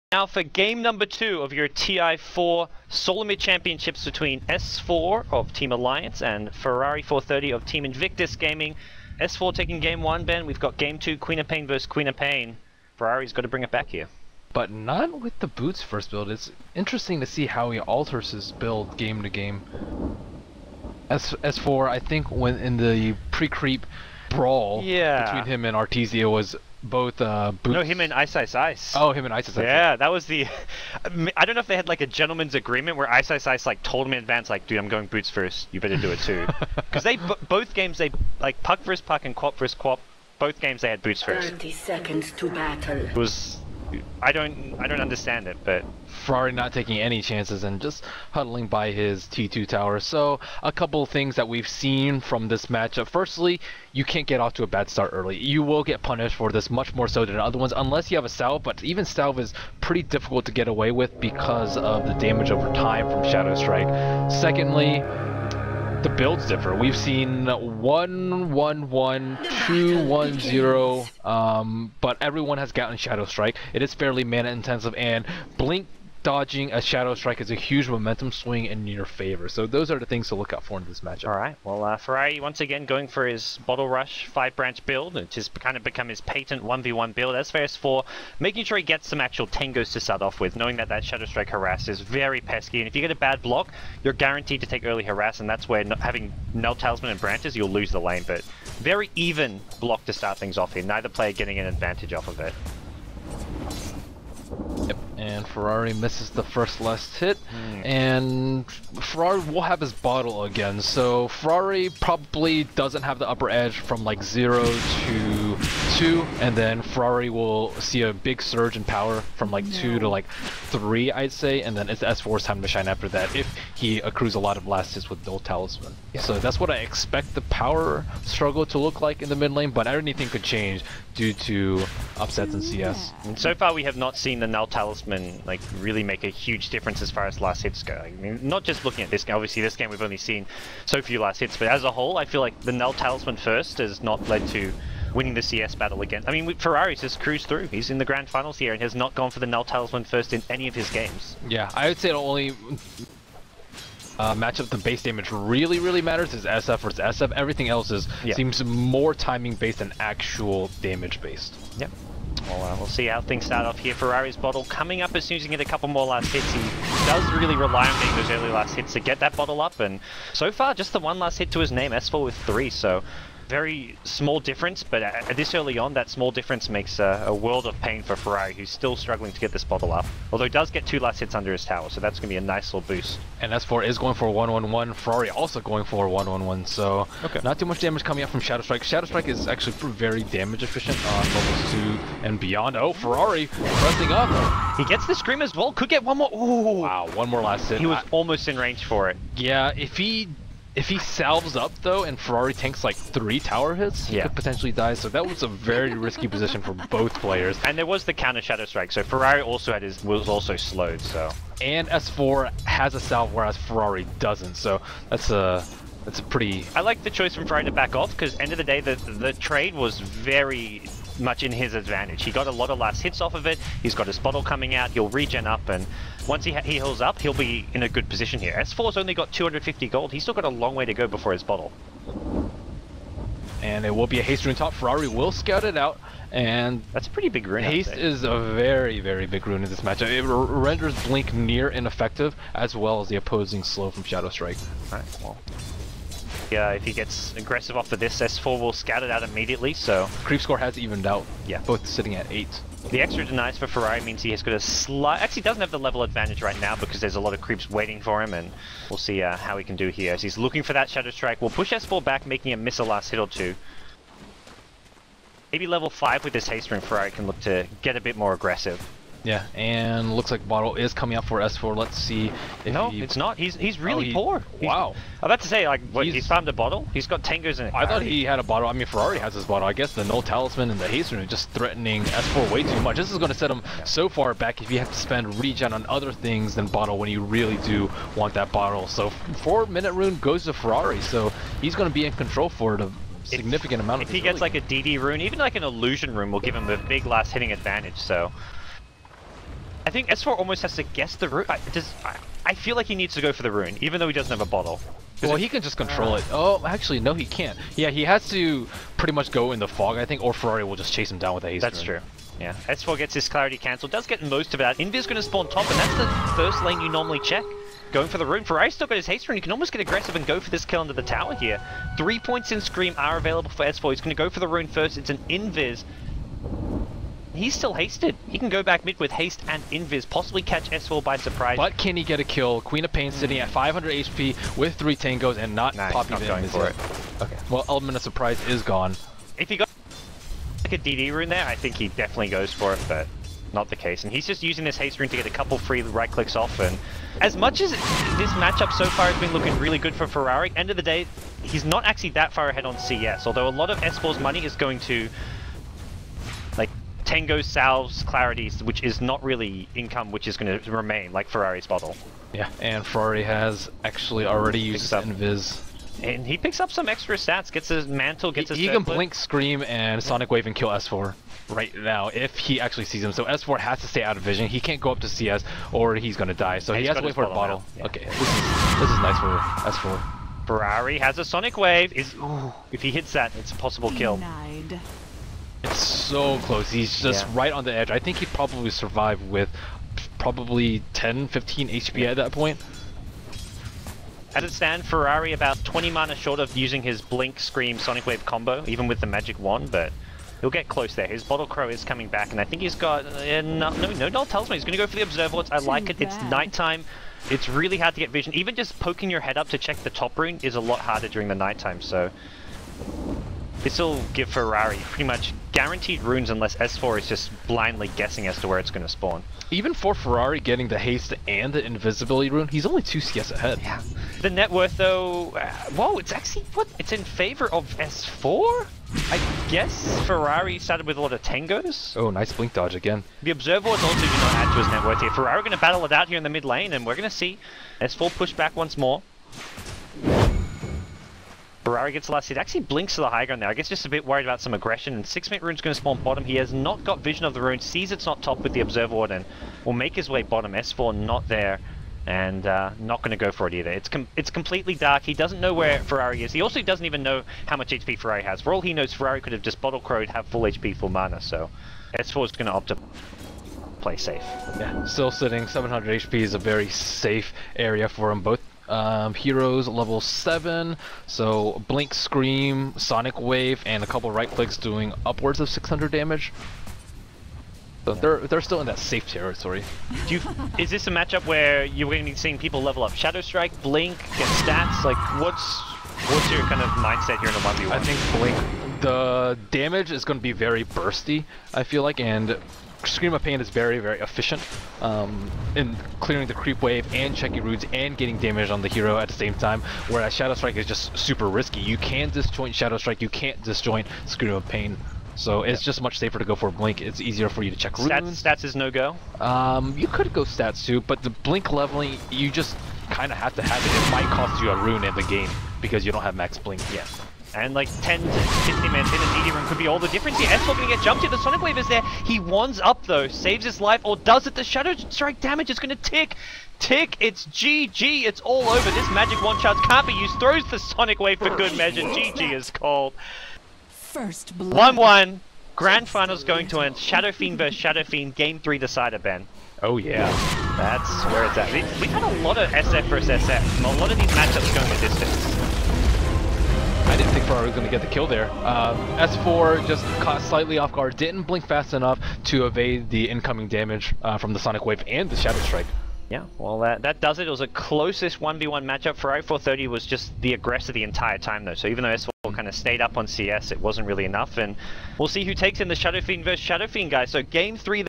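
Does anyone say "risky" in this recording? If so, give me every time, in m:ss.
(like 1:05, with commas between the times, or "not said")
3:25, 8:21.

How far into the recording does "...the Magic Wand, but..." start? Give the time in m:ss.
6:39.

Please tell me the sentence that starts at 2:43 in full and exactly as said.
Ferrari's bottle coming up as soon as he can get a couple more last hits.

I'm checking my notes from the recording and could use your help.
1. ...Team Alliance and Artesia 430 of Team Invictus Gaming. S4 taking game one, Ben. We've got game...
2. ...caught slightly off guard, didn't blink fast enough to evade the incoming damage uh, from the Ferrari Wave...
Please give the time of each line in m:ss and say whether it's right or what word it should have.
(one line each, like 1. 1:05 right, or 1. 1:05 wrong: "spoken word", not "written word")
1. 0:05 wrong: "Ferrari", not "Artesia"
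2. 9:10 wrong: "Sonic", not "Ferrari".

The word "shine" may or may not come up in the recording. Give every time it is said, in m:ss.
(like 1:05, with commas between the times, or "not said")
2:02.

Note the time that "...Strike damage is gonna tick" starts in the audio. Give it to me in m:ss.
8:44.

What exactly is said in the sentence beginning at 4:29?
Yeah, and looks like Bottle is coming up for S4.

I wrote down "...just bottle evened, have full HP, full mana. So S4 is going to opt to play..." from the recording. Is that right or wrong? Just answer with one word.
wrong.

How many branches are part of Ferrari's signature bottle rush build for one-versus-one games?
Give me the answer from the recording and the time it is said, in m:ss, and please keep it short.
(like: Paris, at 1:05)
5, at 1:24.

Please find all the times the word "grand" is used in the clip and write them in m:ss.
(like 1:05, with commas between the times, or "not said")
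2:28, 8:55.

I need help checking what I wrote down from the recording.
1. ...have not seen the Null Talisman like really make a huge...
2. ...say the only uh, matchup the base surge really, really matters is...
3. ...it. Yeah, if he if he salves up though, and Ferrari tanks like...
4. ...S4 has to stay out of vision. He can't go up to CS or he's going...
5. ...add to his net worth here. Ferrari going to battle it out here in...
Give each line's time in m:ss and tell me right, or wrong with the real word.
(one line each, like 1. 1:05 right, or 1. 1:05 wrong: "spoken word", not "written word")
1. 2:13 right
2. 2:31 wrong: "damage", not "surge"
3. 3:19 right
4. 6:13 right
5. 7:14 right.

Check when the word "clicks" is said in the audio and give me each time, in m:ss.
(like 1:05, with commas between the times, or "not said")
5:46, 7:54.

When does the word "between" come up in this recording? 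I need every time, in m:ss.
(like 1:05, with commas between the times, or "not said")
0:04, 0:25.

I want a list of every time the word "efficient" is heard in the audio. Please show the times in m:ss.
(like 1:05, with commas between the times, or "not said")
3:10, 8:13.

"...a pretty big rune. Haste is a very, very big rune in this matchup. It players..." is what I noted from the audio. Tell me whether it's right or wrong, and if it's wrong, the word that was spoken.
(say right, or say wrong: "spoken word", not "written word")
wrong: "renders", not "players".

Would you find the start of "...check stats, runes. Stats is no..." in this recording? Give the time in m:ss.
8:27.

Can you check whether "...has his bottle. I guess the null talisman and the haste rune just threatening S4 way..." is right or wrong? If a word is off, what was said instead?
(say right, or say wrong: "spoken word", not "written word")
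right.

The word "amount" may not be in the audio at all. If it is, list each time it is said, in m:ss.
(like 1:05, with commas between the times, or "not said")
4:53.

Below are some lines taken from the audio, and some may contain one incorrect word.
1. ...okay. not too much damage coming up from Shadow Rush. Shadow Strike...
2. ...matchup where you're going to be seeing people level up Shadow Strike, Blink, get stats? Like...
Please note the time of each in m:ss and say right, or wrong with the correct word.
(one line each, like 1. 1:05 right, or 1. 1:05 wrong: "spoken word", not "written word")
1. 3:07 wrong: "Strike", not "Rush"
2. 8:00 right.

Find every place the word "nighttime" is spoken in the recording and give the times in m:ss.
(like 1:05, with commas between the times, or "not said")
6:46, 6:51.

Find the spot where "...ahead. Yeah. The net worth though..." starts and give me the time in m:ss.
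7:03.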